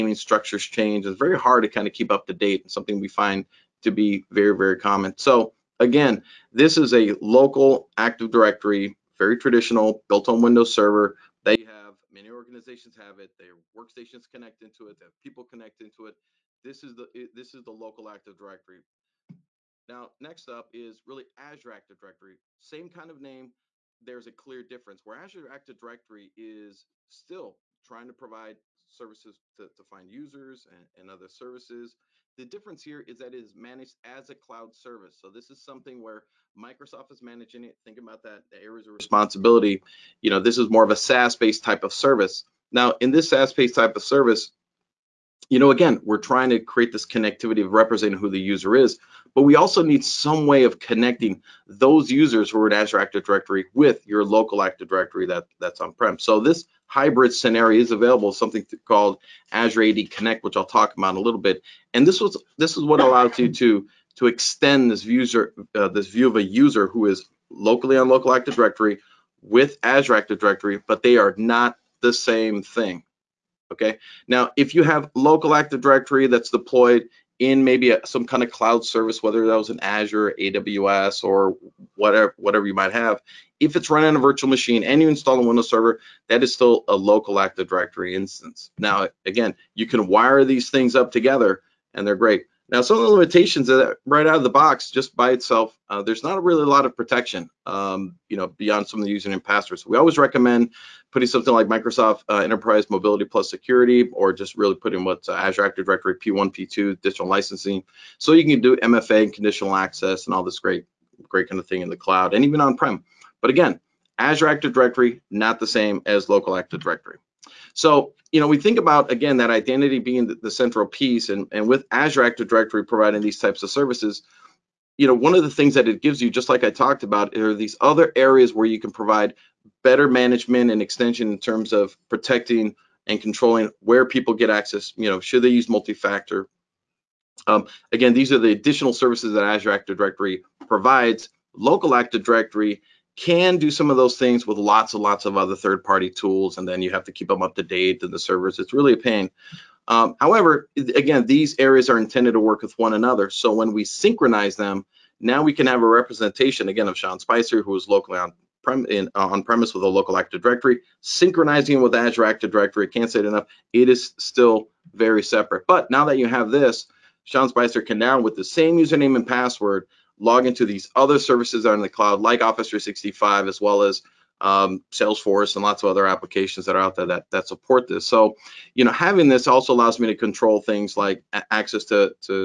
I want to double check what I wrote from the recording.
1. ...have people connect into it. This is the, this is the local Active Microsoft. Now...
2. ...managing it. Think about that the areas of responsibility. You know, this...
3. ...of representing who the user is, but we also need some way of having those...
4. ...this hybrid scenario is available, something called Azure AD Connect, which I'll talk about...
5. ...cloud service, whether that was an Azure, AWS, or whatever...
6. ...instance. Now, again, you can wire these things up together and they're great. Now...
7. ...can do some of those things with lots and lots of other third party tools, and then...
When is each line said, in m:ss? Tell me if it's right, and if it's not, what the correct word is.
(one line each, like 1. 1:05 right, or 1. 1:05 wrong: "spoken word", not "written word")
1. 0:15 wrong: "Directory", not "Microsoft"
2. 0:37 right
3. 0:47 wrong: "connecting", not "having"
4. 0:56 right
5. 1:18 right
6. 1:28 right
7. 2:23 right.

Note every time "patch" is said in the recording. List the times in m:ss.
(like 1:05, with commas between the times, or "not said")
not said.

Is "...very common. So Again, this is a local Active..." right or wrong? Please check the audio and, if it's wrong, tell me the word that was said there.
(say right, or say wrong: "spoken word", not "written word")
right.